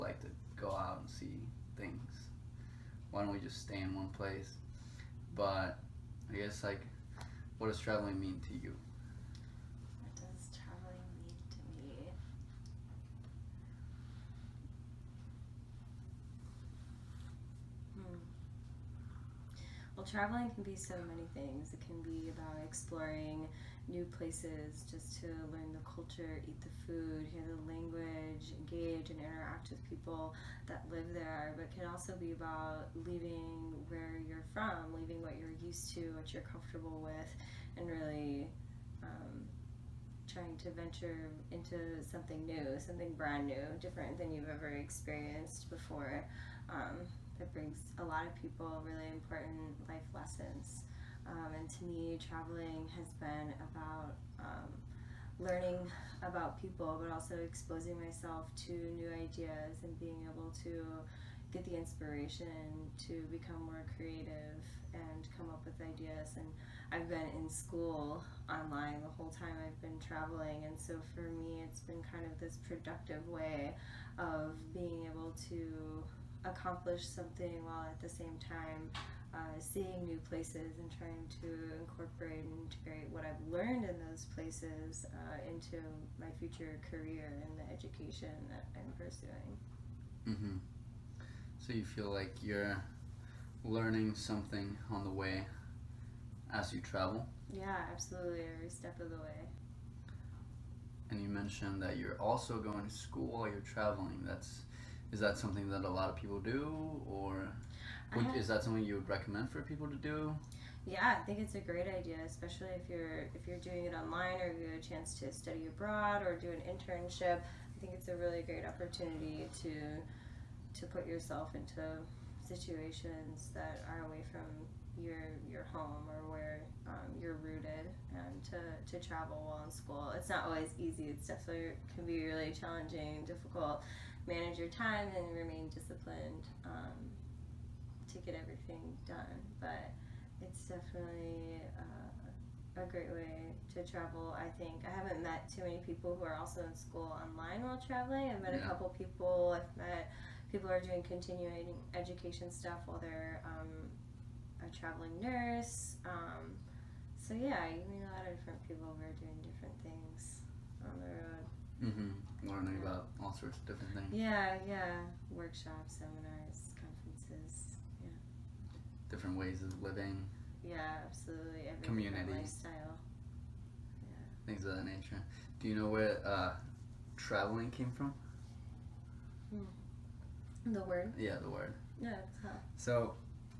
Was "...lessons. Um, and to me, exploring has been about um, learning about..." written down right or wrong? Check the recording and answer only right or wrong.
wrong.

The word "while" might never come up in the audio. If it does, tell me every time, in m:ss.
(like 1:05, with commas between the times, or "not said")
1:17, 1:43, 2:09, 2:27, 2:32.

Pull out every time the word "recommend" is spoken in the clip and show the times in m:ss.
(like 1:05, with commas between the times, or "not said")
1:49.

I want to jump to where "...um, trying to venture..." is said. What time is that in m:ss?
0:39.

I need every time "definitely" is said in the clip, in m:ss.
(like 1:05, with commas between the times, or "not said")
2:11, 2:20.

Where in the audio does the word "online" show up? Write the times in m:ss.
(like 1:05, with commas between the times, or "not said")
1:08, 1:53, 2:27.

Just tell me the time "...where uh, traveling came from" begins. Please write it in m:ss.
2:55.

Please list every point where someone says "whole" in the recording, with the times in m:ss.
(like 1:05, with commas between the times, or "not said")
1:09.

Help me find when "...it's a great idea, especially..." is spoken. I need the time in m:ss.
1:51.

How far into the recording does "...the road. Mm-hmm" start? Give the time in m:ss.
2:40.